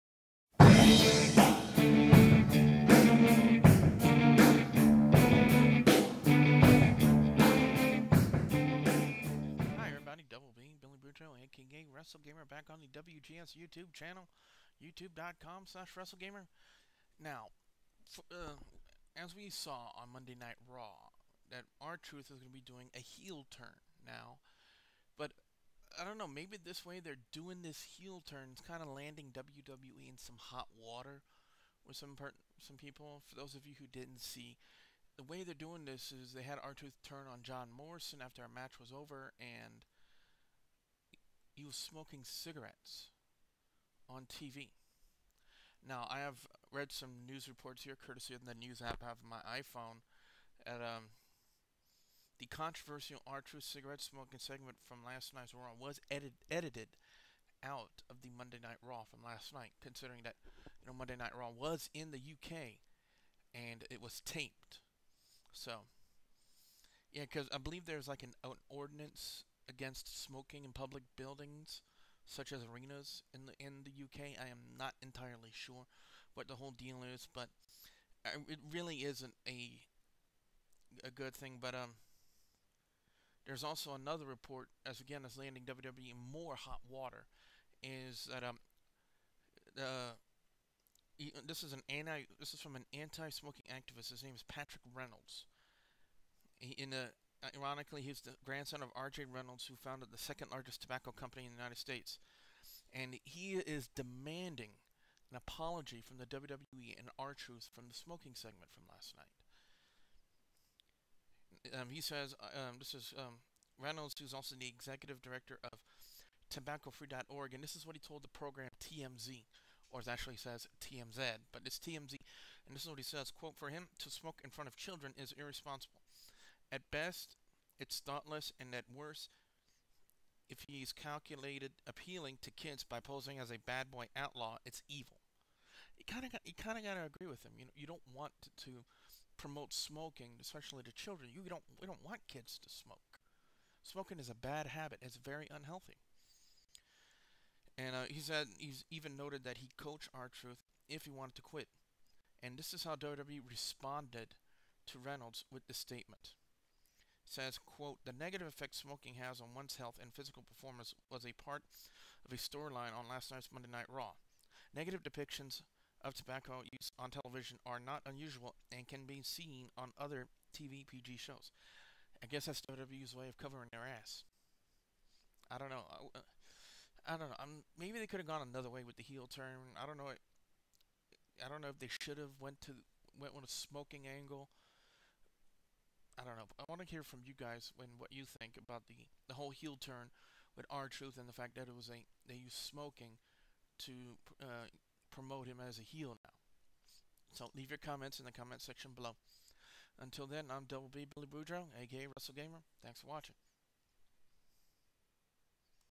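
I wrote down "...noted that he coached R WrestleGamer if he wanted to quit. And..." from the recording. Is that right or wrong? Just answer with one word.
wrong.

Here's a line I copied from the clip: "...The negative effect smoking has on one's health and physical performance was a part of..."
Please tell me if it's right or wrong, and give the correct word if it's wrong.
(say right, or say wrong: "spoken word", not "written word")
right.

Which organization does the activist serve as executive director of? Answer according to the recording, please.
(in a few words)
tobaccofree.org.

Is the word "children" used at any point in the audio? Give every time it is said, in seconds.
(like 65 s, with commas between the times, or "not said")
124 s, 140 s.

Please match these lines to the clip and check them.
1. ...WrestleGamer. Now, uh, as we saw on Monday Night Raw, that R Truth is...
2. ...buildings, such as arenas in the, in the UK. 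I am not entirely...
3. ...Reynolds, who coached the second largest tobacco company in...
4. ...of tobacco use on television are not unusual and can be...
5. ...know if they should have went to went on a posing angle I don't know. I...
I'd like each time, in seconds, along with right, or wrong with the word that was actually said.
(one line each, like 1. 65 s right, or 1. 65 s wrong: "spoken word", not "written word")
1. 15 s right
2. 71 s right
3. 99 s wrong: "founded", not "coached"
4. 166 s right
5. 181 s wrong: "smoking", not "posing".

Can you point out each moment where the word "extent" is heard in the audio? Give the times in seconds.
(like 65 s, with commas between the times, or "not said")
not said.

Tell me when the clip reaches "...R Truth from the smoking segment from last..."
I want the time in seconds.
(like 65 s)
107 s.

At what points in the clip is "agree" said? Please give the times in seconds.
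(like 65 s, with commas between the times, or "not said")
137 s.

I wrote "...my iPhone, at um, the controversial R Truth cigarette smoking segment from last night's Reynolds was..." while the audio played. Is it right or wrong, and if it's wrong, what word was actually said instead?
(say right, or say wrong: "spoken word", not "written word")
wrong: "Raw", not "Reynolds".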